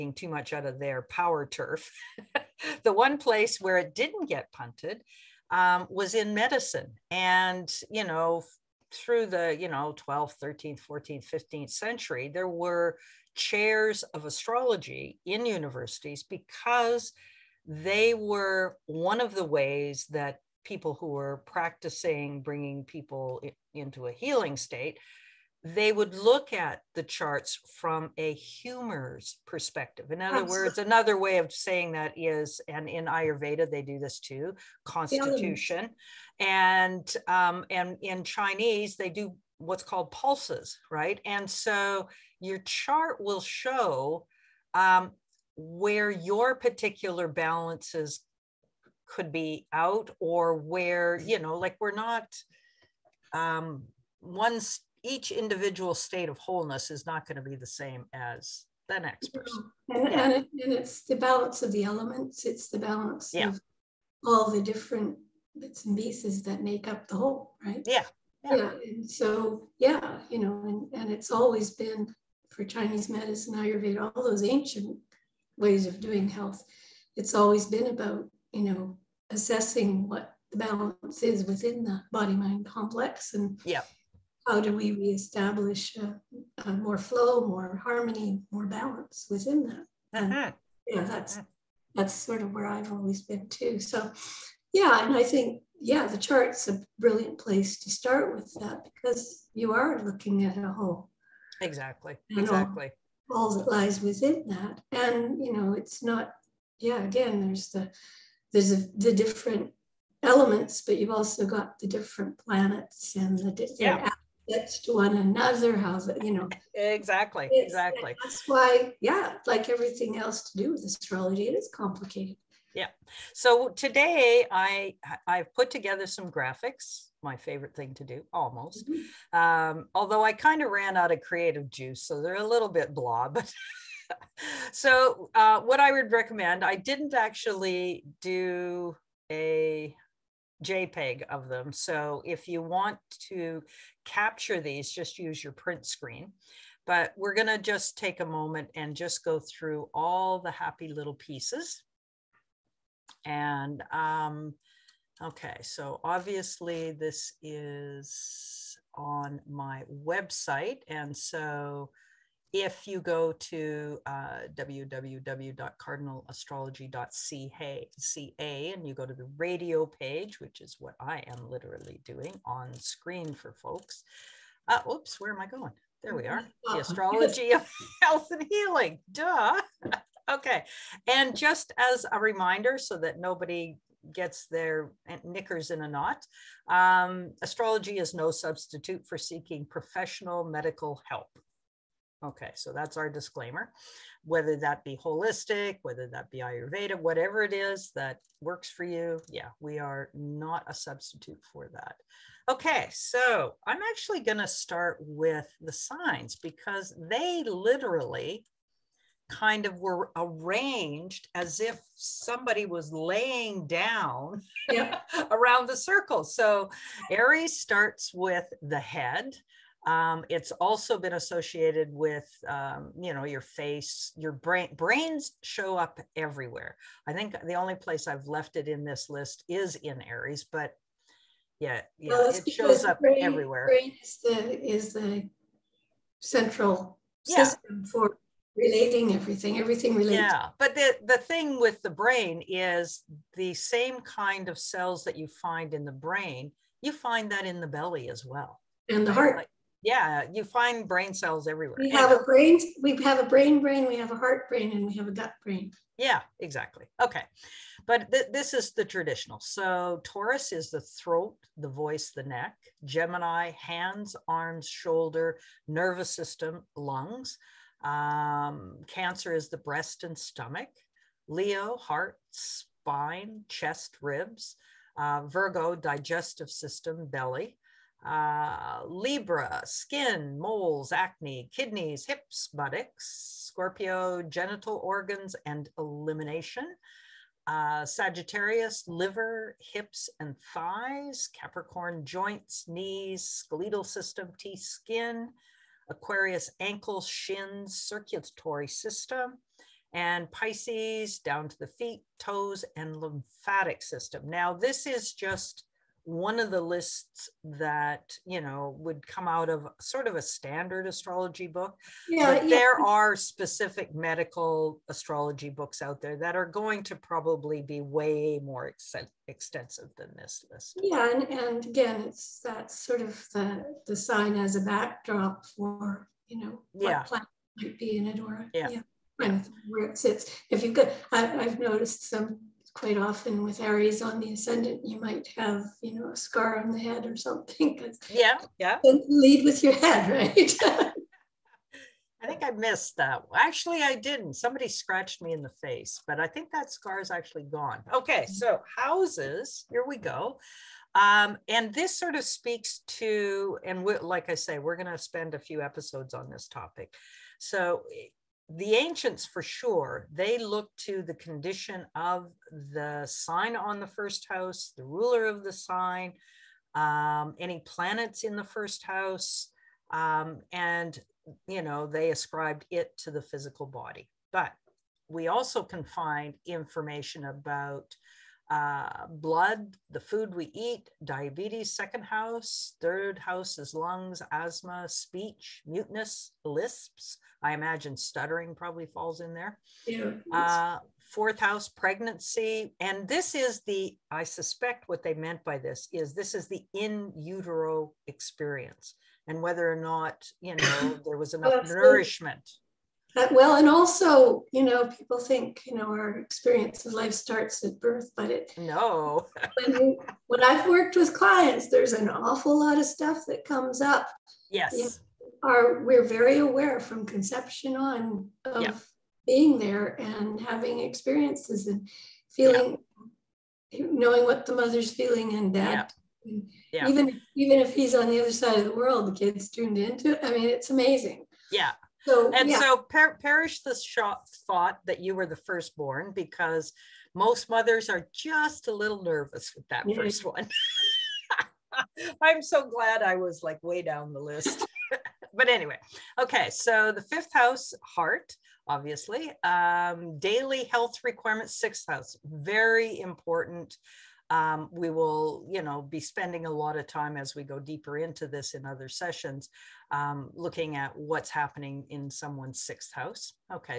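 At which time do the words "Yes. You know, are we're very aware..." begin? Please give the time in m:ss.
6:54.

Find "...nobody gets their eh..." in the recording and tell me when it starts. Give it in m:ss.
3:03.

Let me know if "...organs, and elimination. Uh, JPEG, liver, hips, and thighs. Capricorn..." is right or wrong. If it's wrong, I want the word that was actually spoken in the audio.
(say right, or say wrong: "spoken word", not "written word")
wrong: "Sagittarius", not "JPEG".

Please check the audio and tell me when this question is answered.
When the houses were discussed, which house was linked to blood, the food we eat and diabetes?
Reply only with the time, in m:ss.
6:21.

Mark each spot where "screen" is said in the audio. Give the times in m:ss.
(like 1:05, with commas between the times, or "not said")
2:25, 2:52.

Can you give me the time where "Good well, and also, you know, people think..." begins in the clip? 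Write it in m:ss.
6:42.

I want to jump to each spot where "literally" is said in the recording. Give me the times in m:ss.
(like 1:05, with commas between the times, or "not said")
2:51, 3:27.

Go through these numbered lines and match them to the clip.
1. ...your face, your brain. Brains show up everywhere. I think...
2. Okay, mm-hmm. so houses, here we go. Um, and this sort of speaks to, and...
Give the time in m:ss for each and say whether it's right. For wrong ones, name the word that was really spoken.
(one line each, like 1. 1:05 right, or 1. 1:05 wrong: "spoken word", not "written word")
1. 3:43 right
2. 5:47 right.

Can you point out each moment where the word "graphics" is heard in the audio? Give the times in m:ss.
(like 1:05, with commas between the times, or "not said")
2:06.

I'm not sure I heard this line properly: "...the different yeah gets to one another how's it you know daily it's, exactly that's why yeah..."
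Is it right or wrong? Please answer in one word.
wrong.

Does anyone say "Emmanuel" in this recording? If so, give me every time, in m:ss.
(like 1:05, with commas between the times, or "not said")
not said.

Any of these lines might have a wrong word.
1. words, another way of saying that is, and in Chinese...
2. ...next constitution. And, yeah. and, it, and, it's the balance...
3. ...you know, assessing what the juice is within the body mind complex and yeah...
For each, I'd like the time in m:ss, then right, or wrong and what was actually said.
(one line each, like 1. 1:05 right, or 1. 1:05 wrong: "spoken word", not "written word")
1. 0:30 wrong: "Ayurveda", not "Chinese"
2. 0:58 wrong: "person", not "constitution"
3. 1:18 wrong: "balance", not "juice".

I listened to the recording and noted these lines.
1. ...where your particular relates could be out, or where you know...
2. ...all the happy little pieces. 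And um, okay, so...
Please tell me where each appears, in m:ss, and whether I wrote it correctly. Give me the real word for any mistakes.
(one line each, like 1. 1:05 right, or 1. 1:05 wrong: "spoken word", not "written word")
1. 0:45 wrong: "balances", not "relates"
2. 2:29 right.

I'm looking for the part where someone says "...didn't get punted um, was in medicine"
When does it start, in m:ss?
0:03.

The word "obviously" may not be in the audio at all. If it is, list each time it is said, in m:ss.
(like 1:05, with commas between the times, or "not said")
2:36, 7:28.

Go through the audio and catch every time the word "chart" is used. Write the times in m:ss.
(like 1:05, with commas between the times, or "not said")
0:27, 0:42, 1:36.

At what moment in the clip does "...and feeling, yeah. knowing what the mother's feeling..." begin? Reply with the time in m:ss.
7:01.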